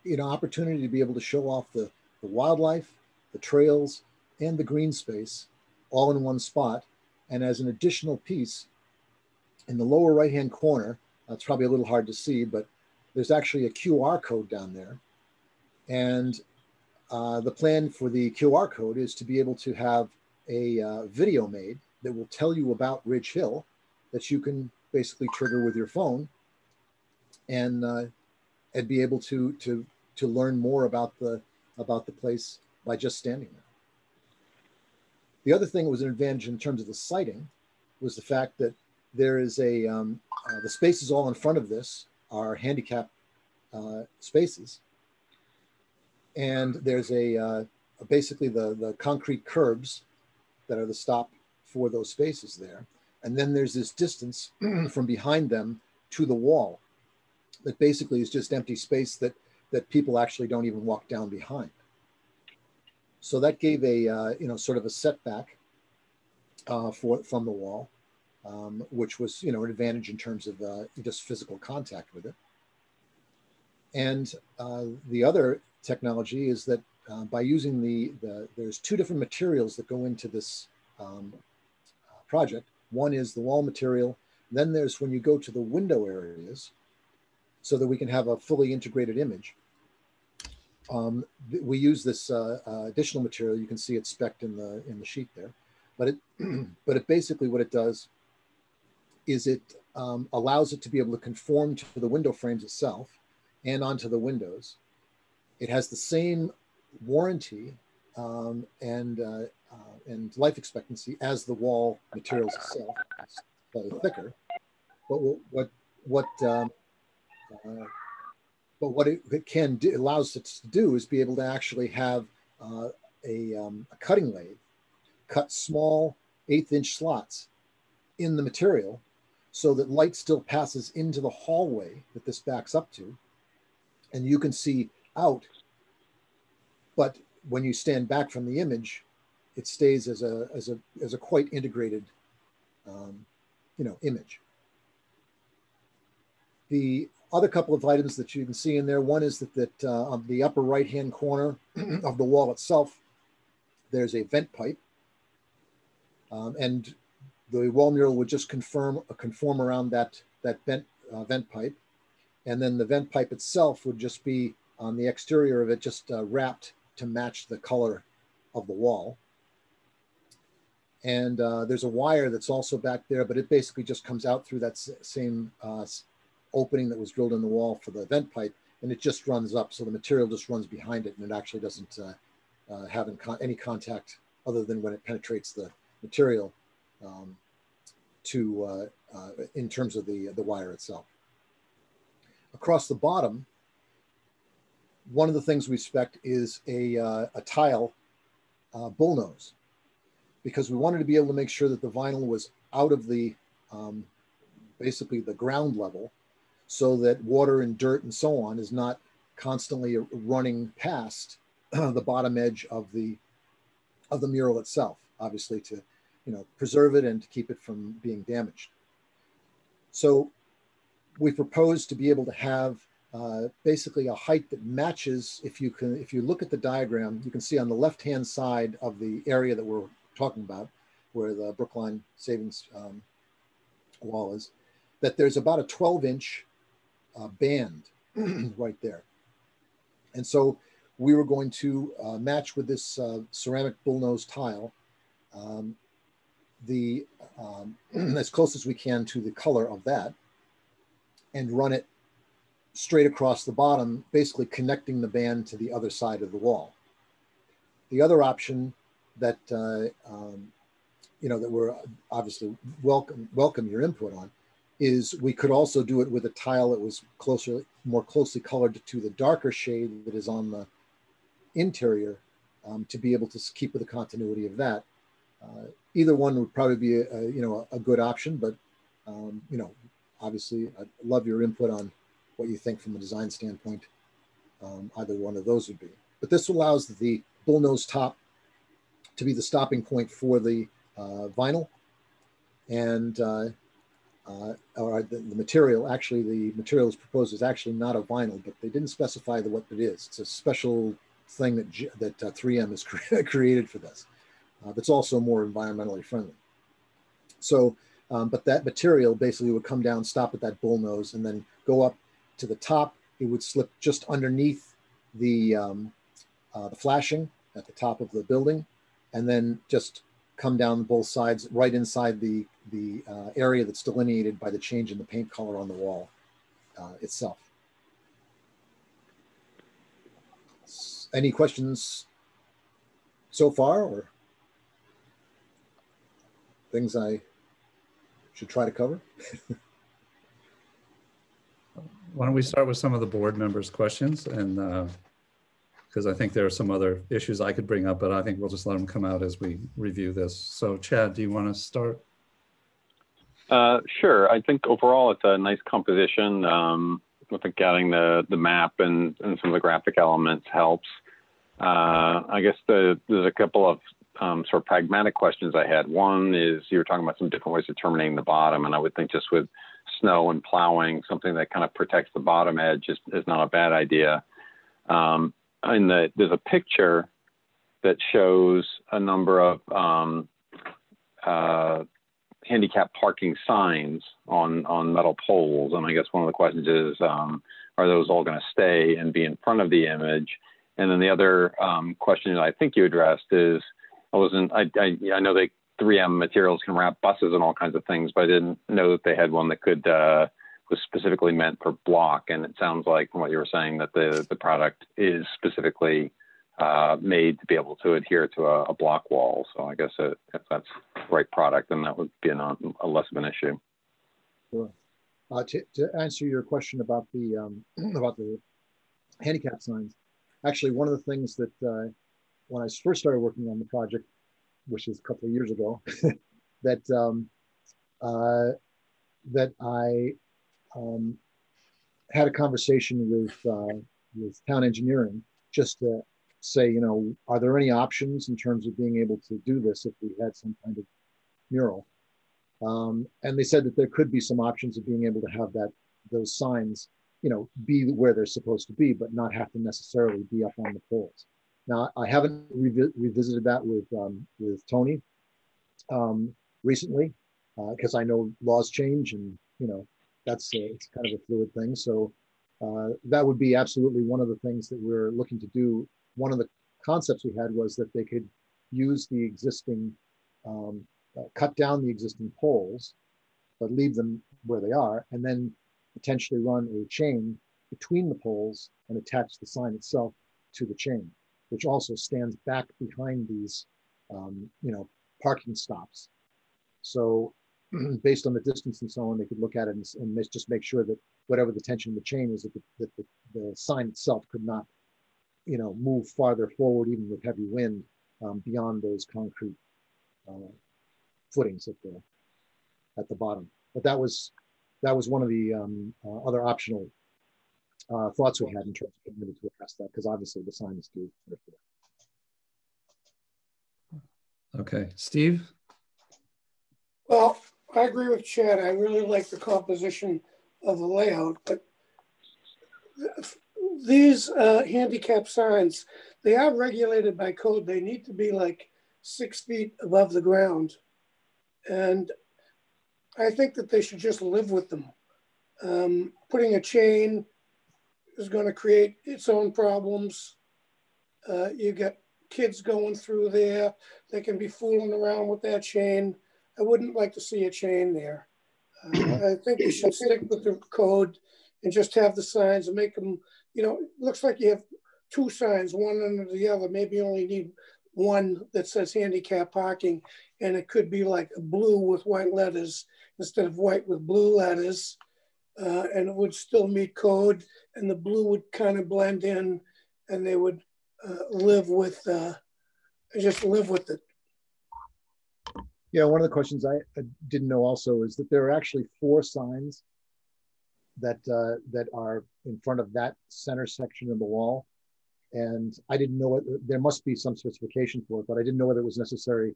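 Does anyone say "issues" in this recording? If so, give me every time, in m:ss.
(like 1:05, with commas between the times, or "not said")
5:47, 6:53.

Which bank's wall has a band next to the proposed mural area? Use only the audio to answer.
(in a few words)
Brookline Savings.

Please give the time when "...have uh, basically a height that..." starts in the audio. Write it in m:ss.
3:42.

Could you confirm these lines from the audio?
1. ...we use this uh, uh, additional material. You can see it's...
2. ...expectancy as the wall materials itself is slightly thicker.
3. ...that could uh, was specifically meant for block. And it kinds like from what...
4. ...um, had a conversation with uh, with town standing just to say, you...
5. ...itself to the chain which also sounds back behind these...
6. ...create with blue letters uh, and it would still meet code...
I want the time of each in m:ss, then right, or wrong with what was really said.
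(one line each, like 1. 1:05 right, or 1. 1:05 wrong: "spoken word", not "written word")
1. 1:31 right
2. 1:50 right
3. 6:39 wrong: "sounds", not "kinds"
4. 7:10 wrong: "engineering", not "standing"
5. 7:59 wrong: "stands", not "sounds"
6. 9:23 wrong: "white", not "create".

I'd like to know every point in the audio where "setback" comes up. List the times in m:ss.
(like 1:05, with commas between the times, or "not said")
1:04.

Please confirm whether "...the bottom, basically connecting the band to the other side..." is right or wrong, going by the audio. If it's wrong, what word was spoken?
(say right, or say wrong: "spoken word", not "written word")
right.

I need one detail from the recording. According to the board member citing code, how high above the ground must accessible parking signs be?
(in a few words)
6 feet.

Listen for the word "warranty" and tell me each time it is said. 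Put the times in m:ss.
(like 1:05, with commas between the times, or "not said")
1:47.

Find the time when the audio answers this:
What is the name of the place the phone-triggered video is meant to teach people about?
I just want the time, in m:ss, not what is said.
0:23.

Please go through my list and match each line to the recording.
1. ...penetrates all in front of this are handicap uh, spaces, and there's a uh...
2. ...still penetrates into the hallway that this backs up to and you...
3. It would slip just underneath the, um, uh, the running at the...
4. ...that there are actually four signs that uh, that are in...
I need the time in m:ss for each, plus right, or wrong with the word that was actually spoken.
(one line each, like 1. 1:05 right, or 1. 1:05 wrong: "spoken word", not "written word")
1. 0:40 wrong: "spaces", not "penetrates"
2. 2:10 wrong: "passes", not "penetrates"
3. 5:13 wrong: "flashing", not "running"
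4. 9:38 right.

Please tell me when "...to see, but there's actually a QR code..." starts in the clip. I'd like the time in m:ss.
0:12.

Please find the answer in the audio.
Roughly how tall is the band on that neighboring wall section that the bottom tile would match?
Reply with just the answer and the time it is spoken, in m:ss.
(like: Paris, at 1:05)
12 inches, at 3:55.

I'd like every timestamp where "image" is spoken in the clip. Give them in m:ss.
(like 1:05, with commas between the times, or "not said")
1:29, 2:18, 2:24, 6:29.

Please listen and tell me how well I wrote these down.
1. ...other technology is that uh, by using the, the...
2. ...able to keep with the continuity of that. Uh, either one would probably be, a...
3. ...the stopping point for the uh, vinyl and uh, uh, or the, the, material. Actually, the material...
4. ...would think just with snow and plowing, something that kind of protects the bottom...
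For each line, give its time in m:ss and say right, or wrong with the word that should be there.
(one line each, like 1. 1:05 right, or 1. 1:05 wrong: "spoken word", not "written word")
1. 1:15 right
2. 4:33 right
3. 4:49 right
4. 6:08 right.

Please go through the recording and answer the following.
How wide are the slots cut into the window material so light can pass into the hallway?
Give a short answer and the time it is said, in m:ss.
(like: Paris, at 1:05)
1/8 inch, at 2:06.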